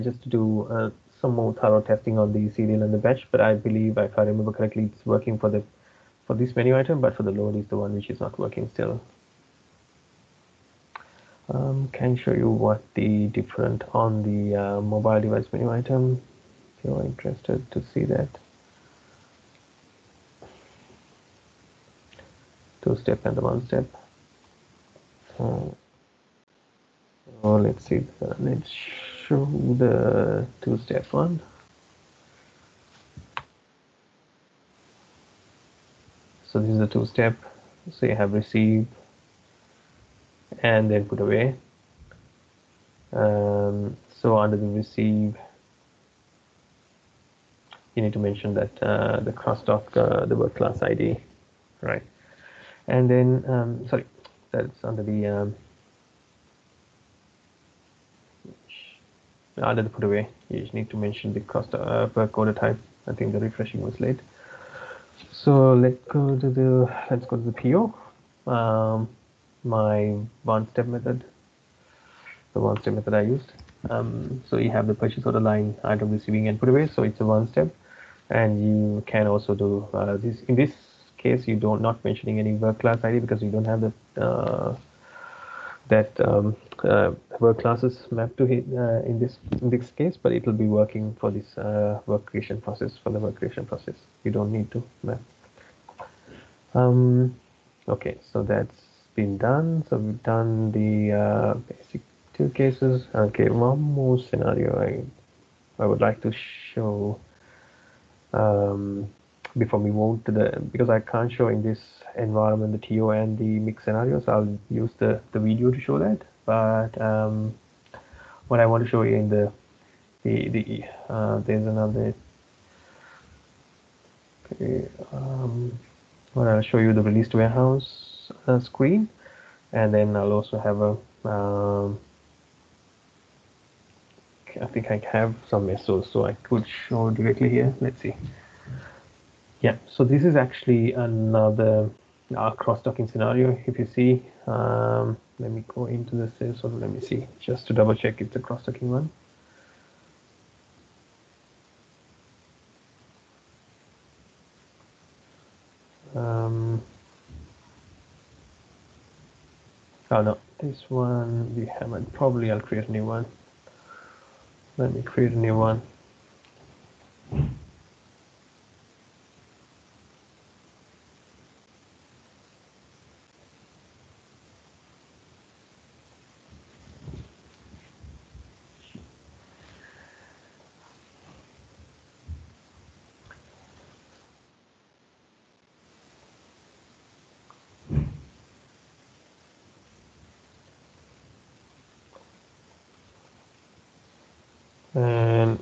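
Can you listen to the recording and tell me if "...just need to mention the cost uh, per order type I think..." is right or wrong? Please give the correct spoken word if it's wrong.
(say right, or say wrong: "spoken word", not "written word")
wrong: "quarter", not "order".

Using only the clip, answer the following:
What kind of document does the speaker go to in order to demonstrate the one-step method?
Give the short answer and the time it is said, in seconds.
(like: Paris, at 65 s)
PO, at 67 s.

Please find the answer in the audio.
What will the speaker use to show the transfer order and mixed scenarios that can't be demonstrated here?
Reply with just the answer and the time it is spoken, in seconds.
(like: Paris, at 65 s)
The video, at 115 s.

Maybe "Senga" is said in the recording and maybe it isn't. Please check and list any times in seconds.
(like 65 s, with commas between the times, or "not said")
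not said.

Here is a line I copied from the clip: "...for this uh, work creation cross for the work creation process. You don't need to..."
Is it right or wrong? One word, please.
wrong.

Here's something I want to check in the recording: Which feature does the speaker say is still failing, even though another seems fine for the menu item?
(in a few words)
The load.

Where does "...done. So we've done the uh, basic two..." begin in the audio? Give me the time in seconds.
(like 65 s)
99 s.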